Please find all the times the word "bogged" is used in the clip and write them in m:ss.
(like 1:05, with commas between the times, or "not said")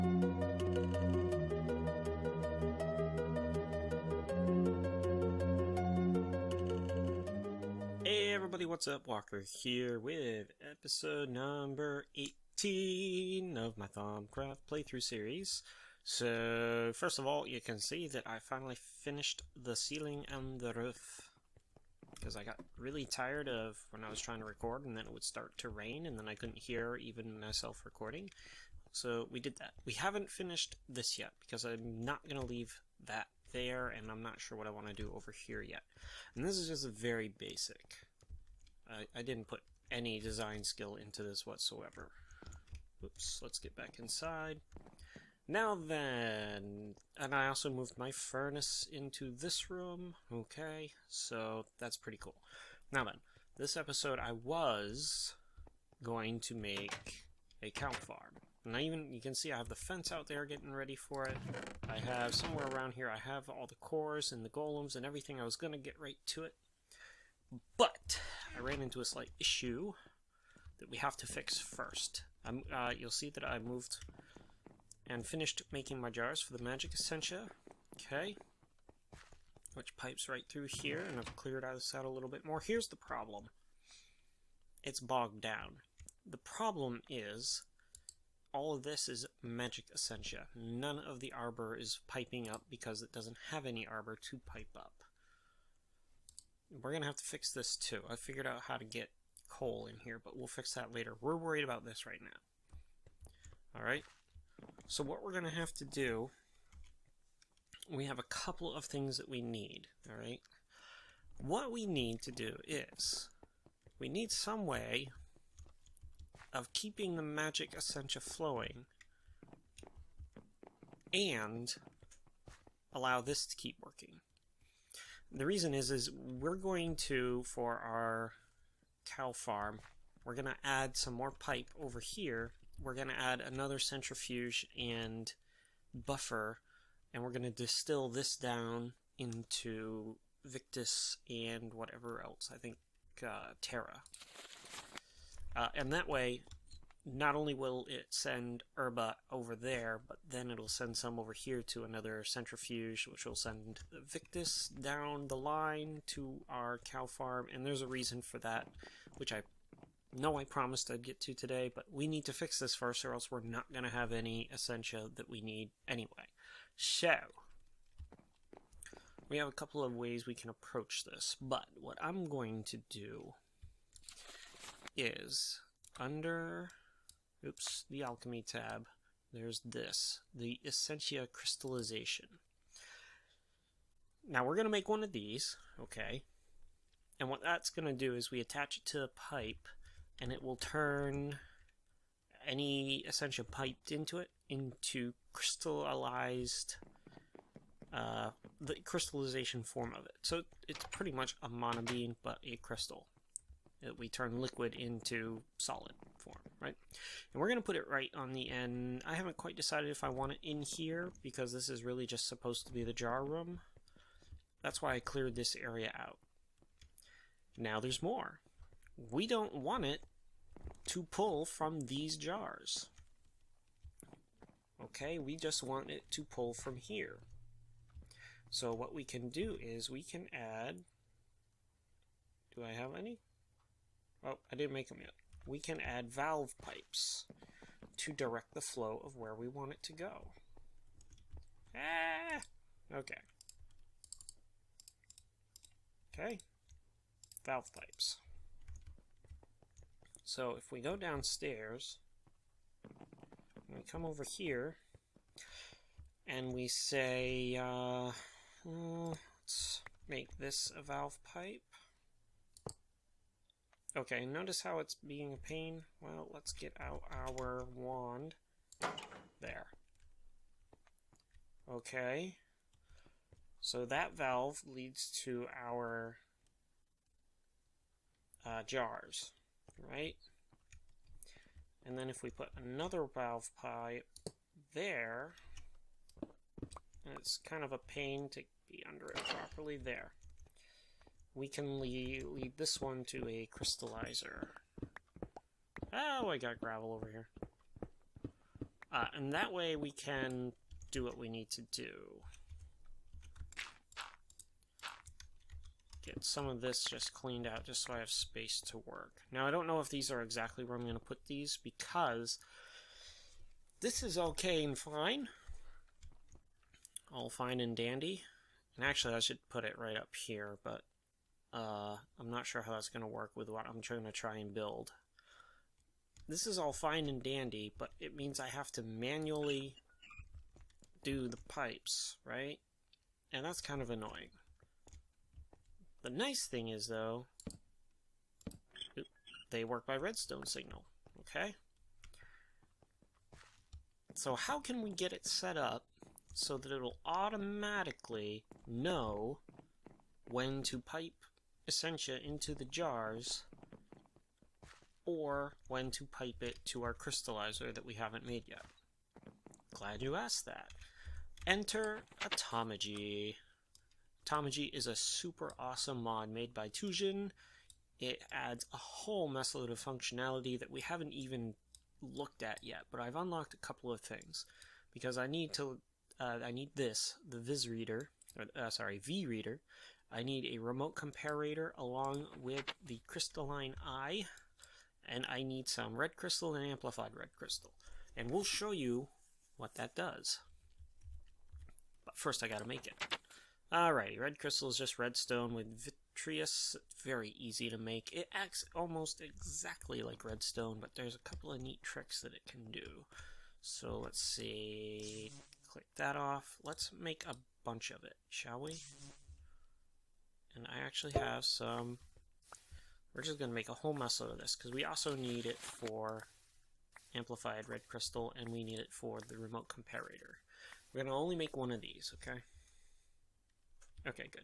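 1:24.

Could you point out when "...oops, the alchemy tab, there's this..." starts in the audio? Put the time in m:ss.
2:57.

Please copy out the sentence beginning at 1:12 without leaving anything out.
Uh, you'll see that I moved and finished making my jars for the magic essentia.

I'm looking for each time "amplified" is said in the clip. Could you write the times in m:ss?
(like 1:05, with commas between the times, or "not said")
6:26, 6:57.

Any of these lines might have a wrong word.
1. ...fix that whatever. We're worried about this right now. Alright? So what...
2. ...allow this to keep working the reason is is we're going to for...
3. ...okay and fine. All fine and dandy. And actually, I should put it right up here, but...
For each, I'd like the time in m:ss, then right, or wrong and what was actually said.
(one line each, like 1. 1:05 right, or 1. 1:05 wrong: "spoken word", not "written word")
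1. 1:40 wrong: "later", not "whatever"
2. 2:02 right
3. 5:14 right.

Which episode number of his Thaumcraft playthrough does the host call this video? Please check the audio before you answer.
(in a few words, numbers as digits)
18.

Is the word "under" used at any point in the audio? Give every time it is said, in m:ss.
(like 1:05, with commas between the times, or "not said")
2:55, 4:48.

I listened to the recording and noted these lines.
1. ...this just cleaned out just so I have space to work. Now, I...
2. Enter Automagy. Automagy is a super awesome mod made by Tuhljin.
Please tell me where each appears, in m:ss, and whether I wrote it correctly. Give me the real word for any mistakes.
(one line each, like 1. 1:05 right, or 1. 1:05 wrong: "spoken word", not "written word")
1. 5:06 right
2. 6:01 right.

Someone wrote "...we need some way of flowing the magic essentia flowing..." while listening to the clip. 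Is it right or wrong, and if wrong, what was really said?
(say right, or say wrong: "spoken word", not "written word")
wrong: "keeping", not "flowing".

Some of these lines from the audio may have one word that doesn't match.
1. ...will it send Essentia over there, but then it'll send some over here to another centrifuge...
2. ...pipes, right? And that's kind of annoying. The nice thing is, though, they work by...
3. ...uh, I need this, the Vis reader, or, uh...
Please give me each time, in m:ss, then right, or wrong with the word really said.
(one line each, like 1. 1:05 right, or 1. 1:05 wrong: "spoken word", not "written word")
1. 2:27 wrong: "Herba", not "Essentia"
2. 5:31 right
3. 6:16 right.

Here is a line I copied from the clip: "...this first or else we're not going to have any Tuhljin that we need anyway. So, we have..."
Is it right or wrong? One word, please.
wrong.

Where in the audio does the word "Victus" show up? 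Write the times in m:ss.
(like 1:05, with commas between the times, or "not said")
2:20, 2:34.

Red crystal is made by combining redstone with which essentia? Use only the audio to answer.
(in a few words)
Vitreus.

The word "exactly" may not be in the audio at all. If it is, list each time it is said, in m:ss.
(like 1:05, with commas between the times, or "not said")
5:10, 6:39.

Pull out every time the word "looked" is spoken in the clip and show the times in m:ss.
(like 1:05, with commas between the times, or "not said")
6:12.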